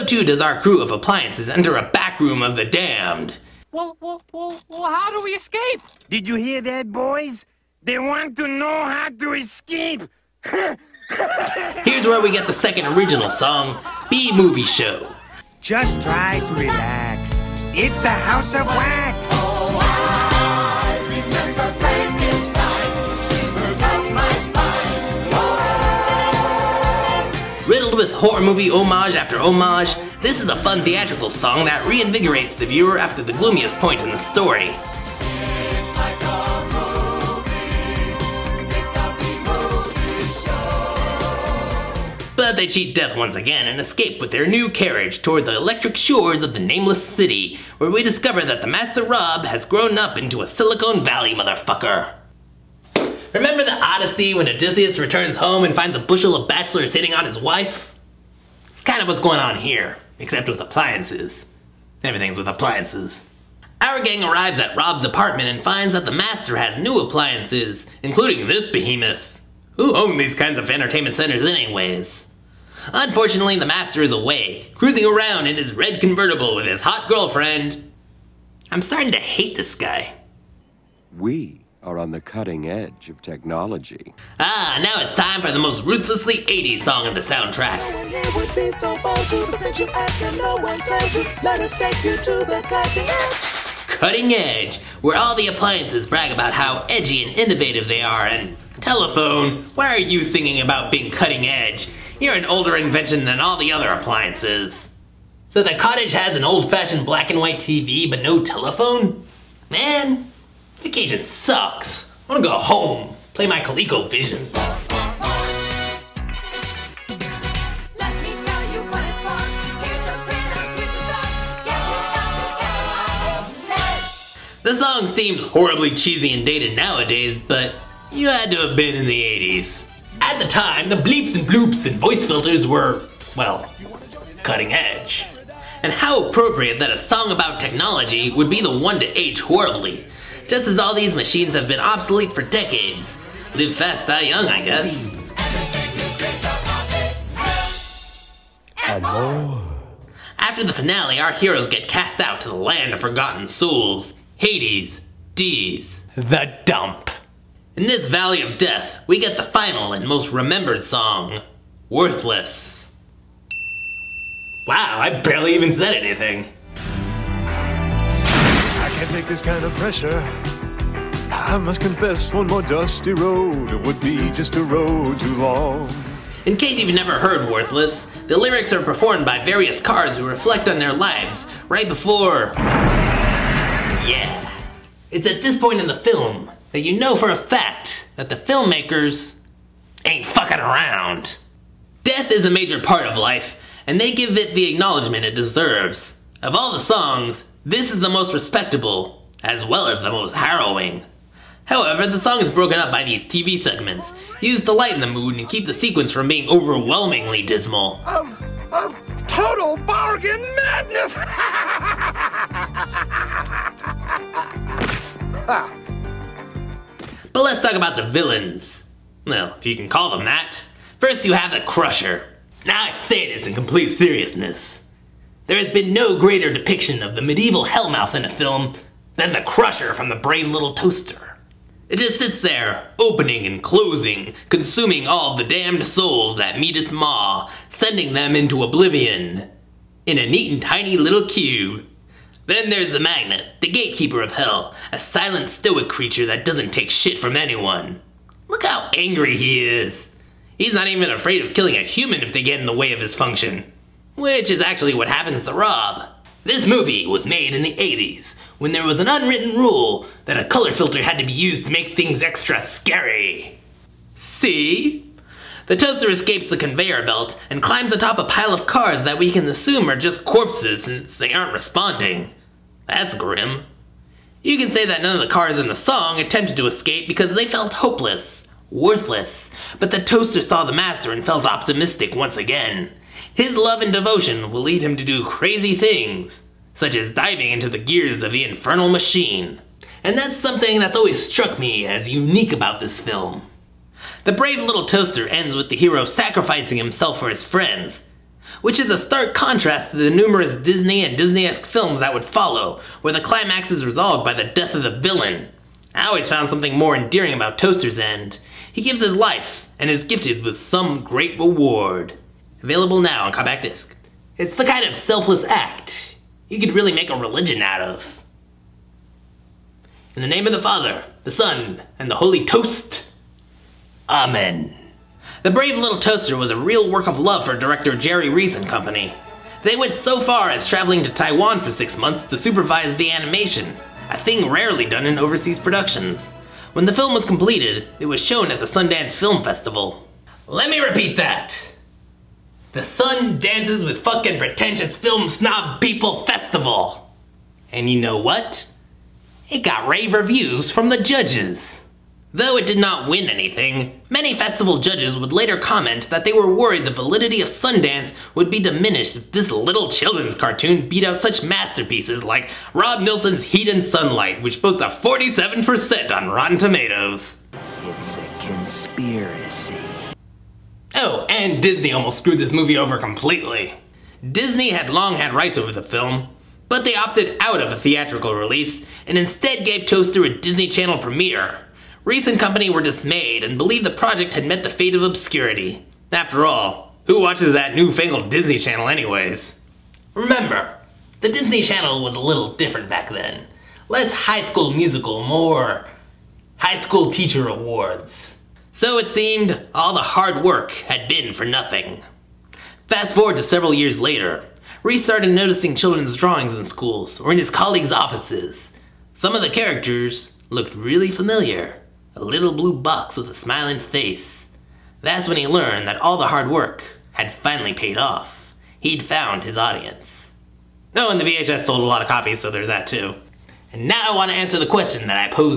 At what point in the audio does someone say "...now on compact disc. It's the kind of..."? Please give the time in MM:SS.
05:12.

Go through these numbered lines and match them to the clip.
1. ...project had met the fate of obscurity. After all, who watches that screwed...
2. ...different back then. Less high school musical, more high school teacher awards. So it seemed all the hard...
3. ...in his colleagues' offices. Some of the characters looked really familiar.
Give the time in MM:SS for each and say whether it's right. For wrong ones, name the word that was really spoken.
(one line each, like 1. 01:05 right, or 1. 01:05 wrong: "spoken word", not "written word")
1. 06:23 wrong: "newfangled", not "screwed"
2. 06:32 right
3. 06:47 right.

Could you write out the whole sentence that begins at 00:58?
It's kind of what's going on here, except with appliances.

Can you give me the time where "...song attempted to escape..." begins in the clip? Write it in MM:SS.
04:35.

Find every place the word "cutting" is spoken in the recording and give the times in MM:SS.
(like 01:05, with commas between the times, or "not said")
01:22, 01:33, 01:41, 02:14.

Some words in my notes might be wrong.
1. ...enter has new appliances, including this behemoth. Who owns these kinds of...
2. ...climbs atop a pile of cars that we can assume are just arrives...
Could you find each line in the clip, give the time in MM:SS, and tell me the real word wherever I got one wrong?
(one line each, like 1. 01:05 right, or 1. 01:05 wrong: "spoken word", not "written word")
1. 01:06 wrong: "master", not "enter"
2. 04:27 wrong: "corpses", not "arrives".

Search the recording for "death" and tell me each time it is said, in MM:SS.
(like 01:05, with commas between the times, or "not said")
00:42, 02:38, 03:12, 05:04.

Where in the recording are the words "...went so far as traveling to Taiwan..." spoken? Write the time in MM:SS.
05:29.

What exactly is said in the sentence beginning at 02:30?
After the finale, our heroes get cast out to the land of forgotten souls, Hades, D's, the dump.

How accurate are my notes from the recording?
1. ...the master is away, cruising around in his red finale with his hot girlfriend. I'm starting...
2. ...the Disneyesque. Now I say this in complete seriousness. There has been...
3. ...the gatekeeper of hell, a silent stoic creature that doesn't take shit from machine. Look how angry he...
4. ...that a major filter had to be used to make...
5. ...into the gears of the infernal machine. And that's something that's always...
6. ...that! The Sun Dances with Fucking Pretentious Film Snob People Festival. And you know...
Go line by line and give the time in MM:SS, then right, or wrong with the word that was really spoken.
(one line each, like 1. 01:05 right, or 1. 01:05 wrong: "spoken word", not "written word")
1. 01:13 wrong: "convertible", not "finale"
2. 03:41 wrong: "Crusher", not "Disneyesque"
3. 04:03 wrong: "anyone", not "machine"
4. 04:20 wrong: "color", not "major"
5. 04:47 right
6. 05:41 right.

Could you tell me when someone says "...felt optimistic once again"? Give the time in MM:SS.
04:41.